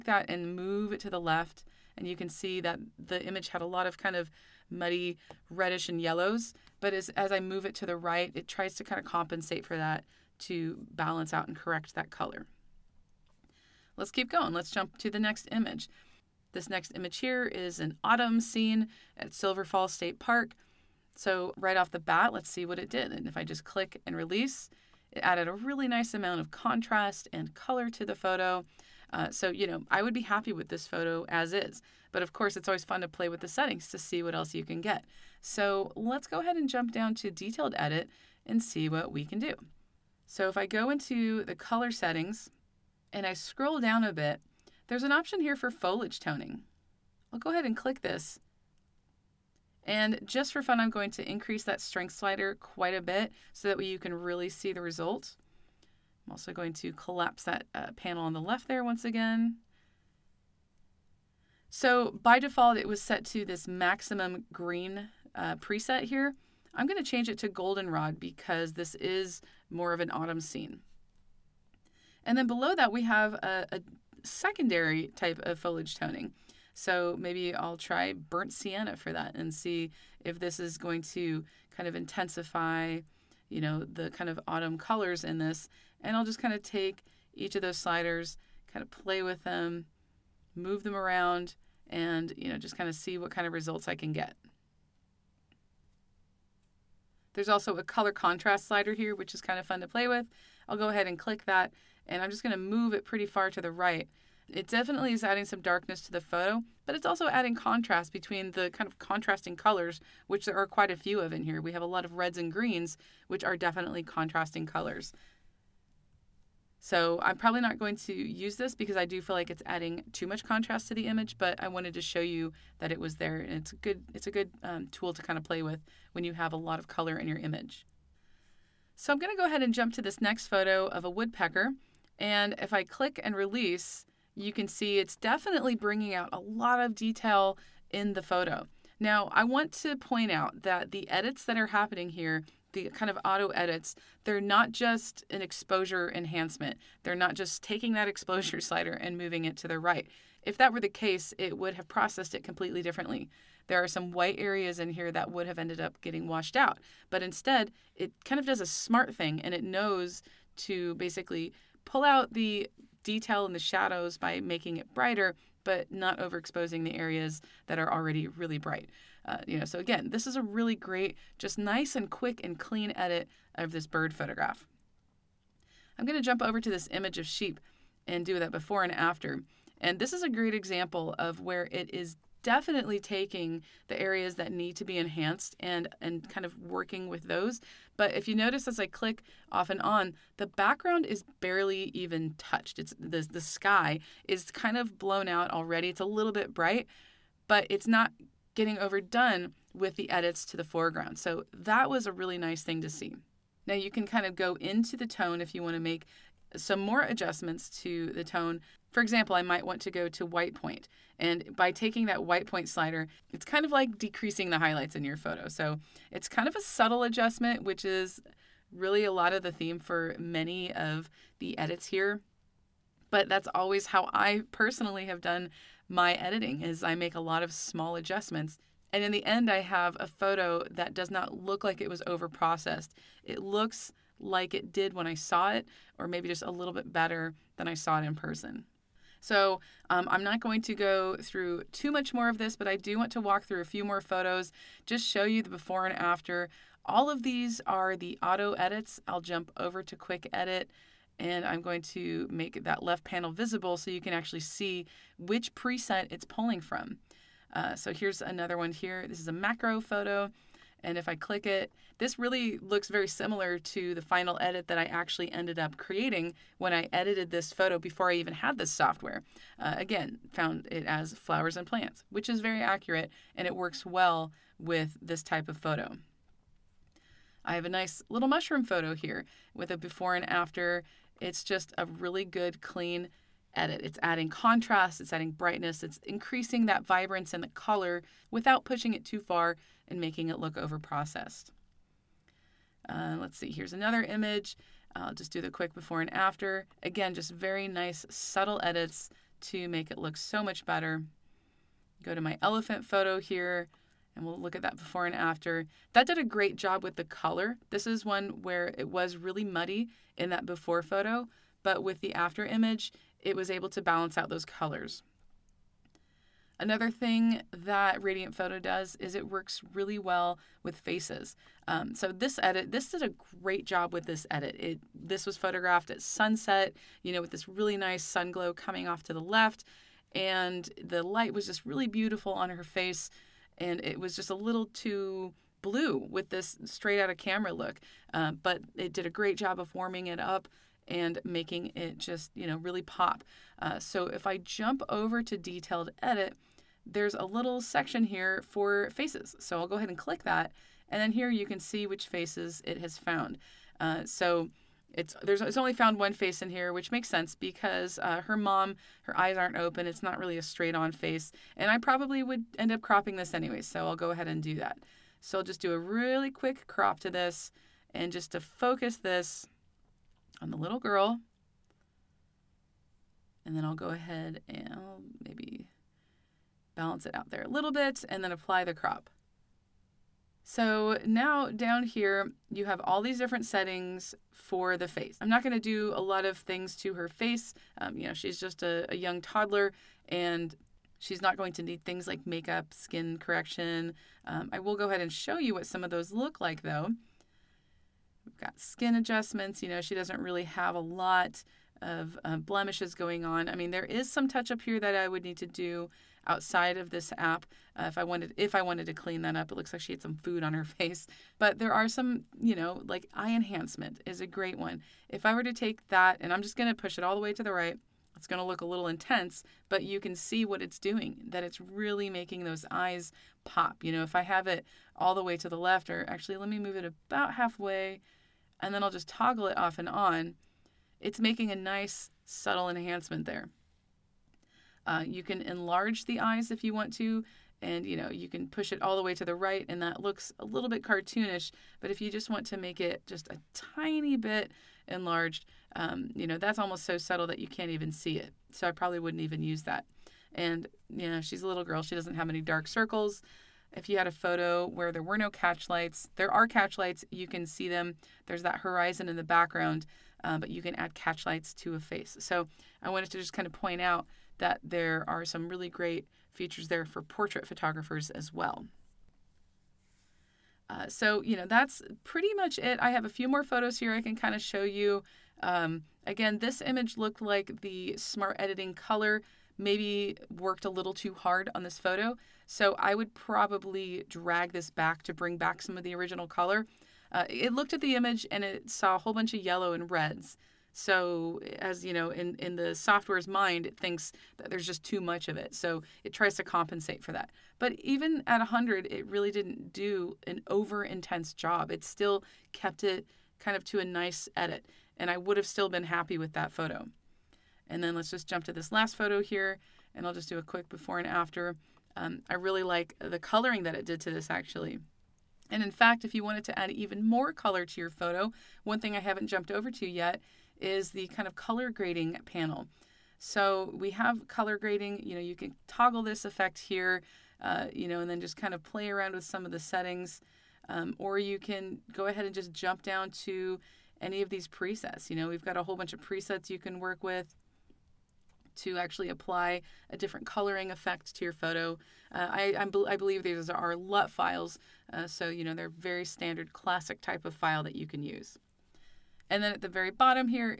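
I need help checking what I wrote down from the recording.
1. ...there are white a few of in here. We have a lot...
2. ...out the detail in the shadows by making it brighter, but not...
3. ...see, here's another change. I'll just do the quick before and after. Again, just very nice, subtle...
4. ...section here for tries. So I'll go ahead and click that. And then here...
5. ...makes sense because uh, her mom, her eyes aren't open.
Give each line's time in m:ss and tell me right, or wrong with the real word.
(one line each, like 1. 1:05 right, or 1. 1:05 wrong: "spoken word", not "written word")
1. 1:50 wrong: "quite", not "white"
2. 2:42 right
3. 4:53 wrong: "image", not "change"
4. 5:47 wrong: "faces", not "tries"
5. 5:56 right.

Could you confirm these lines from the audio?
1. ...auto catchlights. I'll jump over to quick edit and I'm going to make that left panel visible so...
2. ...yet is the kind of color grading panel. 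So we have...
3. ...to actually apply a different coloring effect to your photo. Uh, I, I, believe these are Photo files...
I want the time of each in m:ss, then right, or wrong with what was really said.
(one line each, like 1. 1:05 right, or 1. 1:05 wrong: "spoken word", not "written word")
1. 4:08 wrong: "edits", not "catchlights"
2. 8:39 right
3. 8:58 wrong: "LUT", not "Photo".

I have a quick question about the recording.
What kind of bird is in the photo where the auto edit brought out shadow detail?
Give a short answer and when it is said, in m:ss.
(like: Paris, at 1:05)
Woodpecker, at 2:11.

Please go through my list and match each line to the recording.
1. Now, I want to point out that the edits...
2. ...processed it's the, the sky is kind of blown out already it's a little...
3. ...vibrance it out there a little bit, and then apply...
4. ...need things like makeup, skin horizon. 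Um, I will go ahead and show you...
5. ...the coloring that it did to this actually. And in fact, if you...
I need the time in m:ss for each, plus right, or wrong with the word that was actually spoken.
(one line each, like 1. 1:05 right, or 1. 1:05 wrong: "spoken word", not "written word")
1. 2:18 right
2. 3:12 wrong: "touched", not "processed"
3. 6:16 wrong: "balance", not "vibrance"
4. 6:31 wrong: "correction", not "horizon"
5. 8:33 right.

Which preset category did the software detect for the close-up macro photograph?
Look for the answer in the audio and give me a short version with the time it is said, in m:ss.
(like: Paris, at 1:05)
Flowers and plants, at 4:31.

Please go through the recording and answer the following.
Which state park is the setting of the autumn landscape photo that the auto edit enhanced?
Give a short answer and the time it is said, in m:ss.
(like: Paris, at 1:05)
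Silver Falls State Park, at 0:19.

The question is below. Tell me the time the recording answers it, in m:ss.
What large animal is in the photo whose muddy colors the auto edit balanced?
5:02.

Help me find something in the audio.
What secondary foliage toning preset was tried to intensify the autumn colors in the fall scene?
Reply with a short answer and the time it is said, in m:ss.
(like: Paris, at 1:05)
Burnt sienna, at 1:18.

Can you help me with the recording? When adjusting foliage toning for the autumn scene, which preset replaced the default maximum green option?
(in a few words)
Goldenrod.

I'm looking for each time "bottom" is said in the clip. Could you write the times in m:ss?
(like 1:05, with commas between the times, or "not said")
9:09.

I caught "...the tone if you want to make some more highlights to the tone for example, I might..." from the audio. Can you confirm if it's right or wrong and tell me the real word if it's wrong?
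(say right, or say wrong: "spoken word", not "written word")
wrong: "adjustments", not "highlights".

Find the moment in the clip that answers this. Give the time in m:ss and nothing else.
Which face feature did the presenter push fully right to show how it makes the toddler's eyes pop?
6:53.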